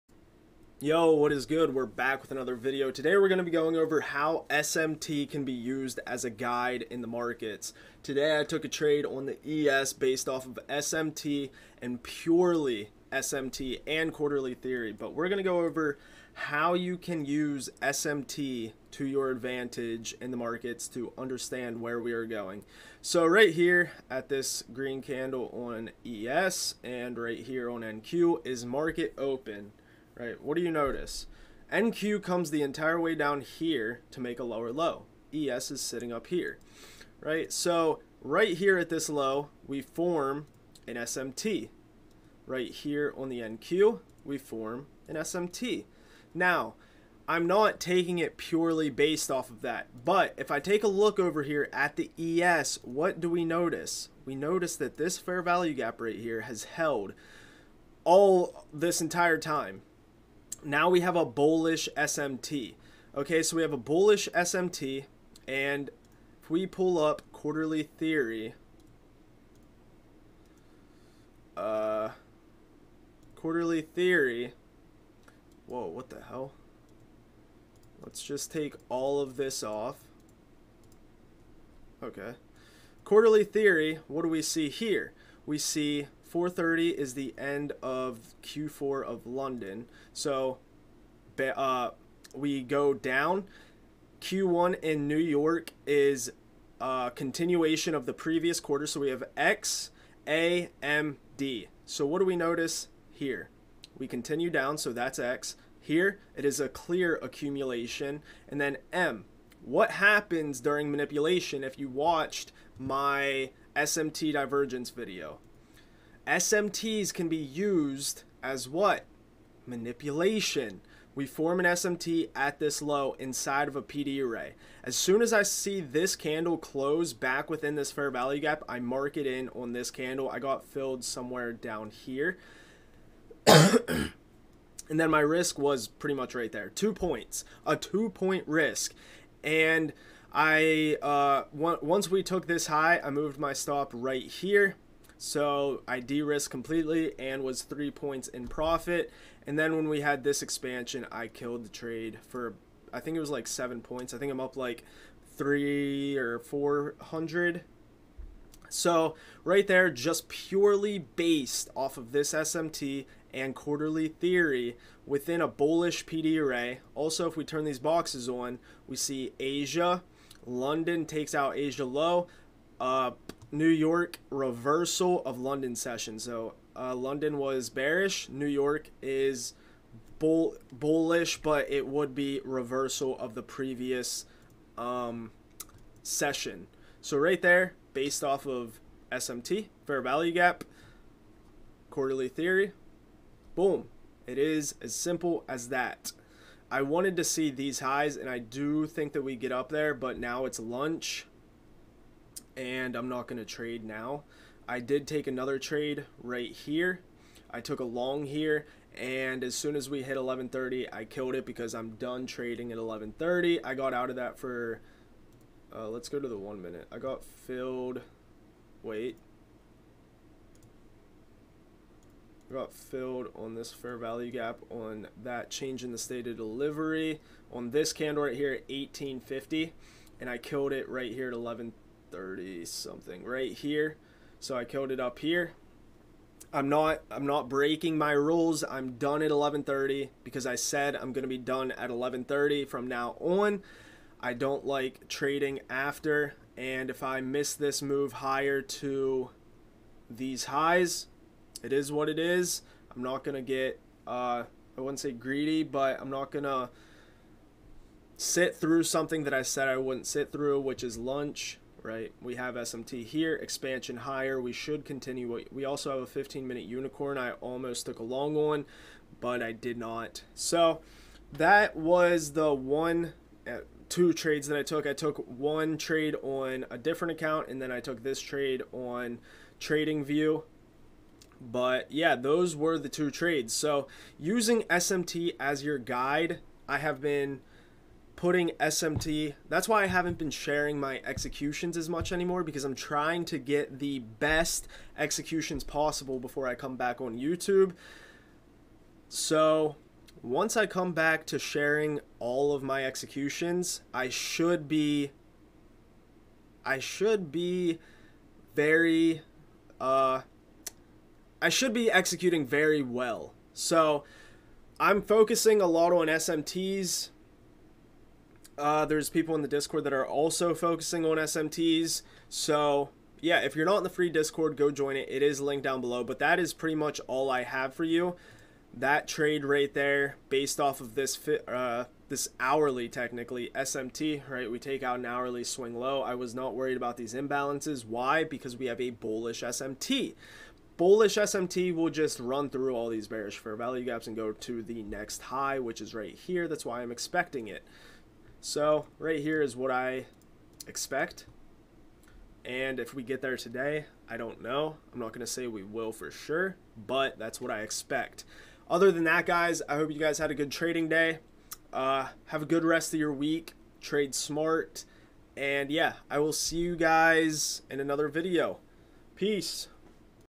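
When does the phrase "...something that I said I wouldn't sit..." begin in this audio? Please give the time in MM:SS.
04:18.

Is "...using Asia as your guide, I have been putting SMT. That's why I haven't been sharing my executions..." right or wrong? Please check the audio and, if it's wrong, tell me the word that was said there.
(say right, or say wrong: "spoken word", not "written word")
wrong: "SMT", not "Asia".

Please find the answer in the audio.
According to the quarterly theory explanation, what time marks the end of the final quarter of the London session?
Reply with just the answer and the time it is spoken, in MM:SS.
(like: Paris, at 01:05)
4:30, at 01:26.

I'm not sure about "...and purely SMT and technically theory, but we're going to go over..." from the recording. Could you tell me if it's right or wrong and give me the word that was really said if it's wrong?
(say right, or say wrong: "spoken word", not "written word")
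wrong: "quarterly", not "technically".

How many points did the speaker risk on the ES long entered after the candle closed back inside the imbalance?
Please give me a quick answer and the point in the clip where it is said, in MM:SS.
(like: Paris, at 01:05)
2, at 02:16.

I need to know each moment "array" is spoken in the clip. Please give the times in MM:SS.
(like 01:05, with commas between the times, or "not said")
02:04, 02:46.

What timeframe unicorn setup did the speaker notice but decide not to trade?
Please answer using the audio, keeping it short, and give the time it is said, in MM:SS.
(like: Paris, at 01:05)
15 minute, at 04:26.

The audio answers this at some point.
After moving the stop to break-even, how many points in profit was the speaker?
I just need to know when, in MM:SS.
02:27.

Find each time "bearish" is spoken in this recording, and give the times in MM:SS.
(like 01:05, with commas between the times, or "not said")
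02:57, 05:43.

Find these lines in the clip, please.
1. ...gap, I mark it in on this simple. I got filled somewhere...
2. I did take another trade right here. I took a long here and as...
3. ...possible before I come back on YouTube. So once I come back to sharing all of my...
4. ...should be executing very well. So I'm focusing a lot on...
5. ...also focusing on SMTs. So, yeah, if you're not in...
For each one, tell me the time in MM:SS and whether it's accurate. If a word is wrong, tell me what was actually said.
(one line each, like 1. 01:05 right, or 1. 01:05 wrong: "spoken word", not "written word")
1. 02:08 wrong: "candle", not "simple"
2. 03:24 right
3. 04:55 right
4. 05:11 right
5. 05:20 right.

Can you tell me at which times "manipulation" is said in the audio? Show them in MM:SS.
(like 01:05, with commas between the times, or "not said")
01:50, 01:59.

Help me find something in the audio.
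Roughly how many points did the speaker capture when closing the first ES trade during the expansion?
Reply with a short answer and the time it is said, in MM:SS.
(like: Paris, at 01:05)
7, at 02:33.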